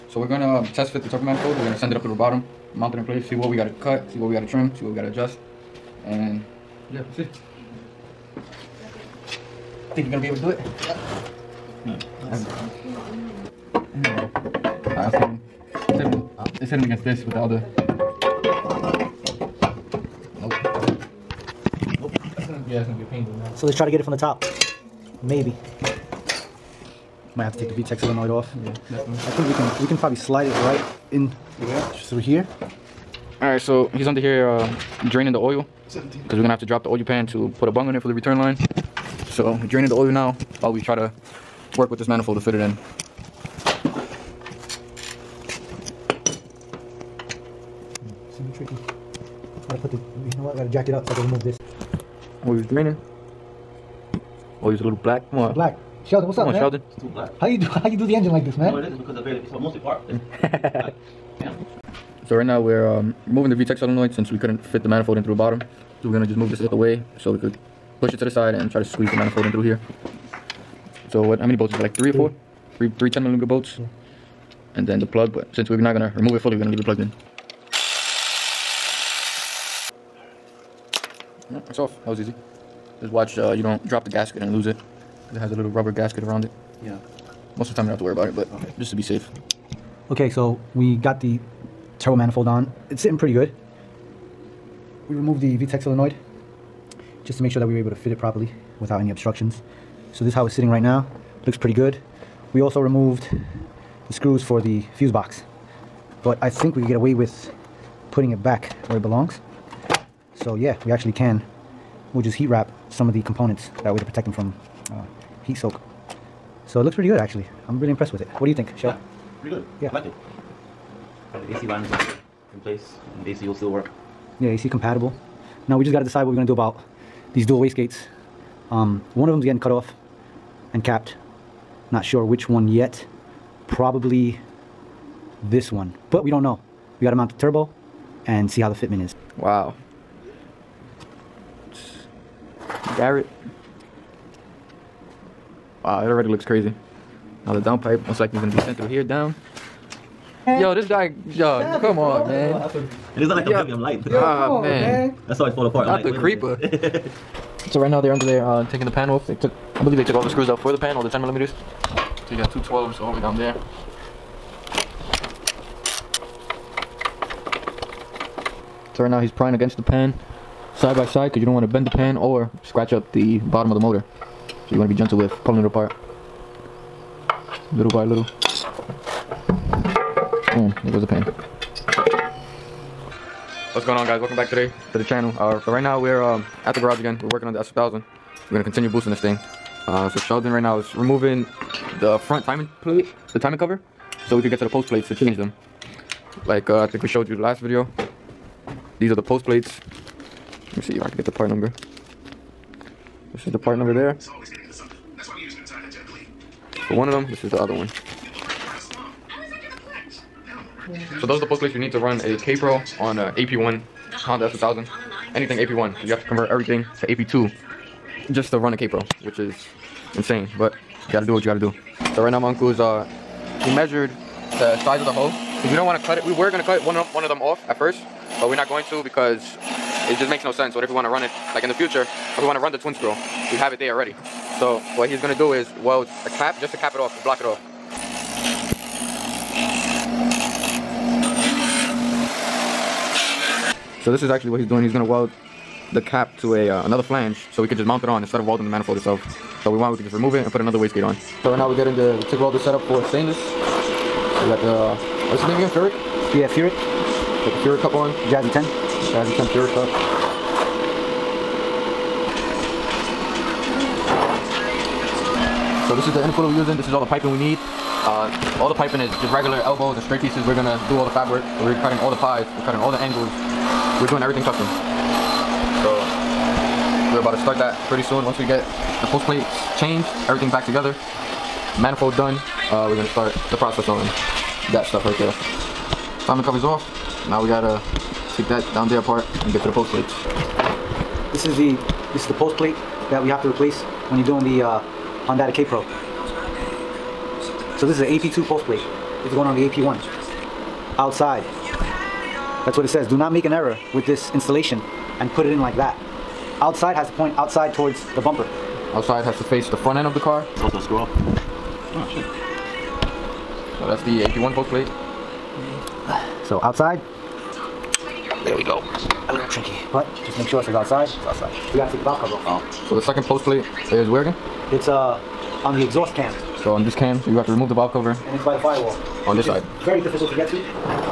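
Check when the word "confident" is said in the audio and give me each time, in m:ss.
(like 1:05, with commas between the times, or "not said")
not said.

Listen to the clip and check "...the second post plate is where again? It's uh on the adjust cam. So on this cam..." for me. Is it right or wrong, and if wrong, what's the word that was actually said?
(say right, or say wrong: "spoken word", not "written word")
wrong: "exhaust", not "adjust".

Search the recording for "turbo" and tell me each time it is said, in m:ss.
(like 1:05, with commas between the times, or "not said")
0:01, 1:31, 2:17.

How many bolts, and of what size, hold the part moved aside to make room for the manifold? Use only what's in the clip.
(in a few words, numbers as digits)
3 10 millimeter bolts.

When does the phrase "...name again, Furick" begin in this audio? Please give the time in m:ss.
4:15.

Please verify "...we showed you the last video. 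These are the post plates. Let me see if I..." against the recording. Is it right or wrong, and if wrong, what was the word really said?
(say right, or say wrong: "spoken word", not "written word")
right.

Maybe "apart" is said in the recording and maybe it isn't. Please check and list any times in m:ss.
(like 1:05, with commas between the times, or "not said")
2:35, 2:55, 4:48.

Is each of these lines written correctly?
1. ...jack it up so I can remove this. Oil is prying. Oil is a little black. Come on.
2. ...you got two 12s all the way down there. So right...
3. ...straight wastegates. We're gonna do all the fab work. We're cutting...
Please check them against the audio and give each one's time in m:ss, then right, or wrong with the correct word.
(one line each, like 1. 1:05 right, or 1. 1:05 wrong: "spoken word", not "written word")
1. 0:50 wrong: "draining", not "prying"
2. 2:42 right
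3. 4:30 wrong: "pieces", not "wastegates".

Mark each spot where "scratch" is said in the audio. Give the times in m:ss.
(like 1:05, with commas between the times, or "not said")
2:52.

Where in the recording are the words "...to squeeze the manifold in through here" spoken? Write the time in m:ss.
1:08.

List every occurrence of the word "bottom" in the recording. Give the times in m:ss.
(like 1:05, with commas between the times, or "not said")
0:02, 1:05, 2:53.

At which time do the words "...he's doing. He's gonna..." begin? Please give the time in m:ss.
4:04.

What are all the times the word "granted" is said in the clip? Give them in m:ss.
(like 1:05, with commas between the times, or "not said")
not said.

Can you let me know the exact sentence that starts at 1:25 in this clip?
It has a little rubber gasket around it.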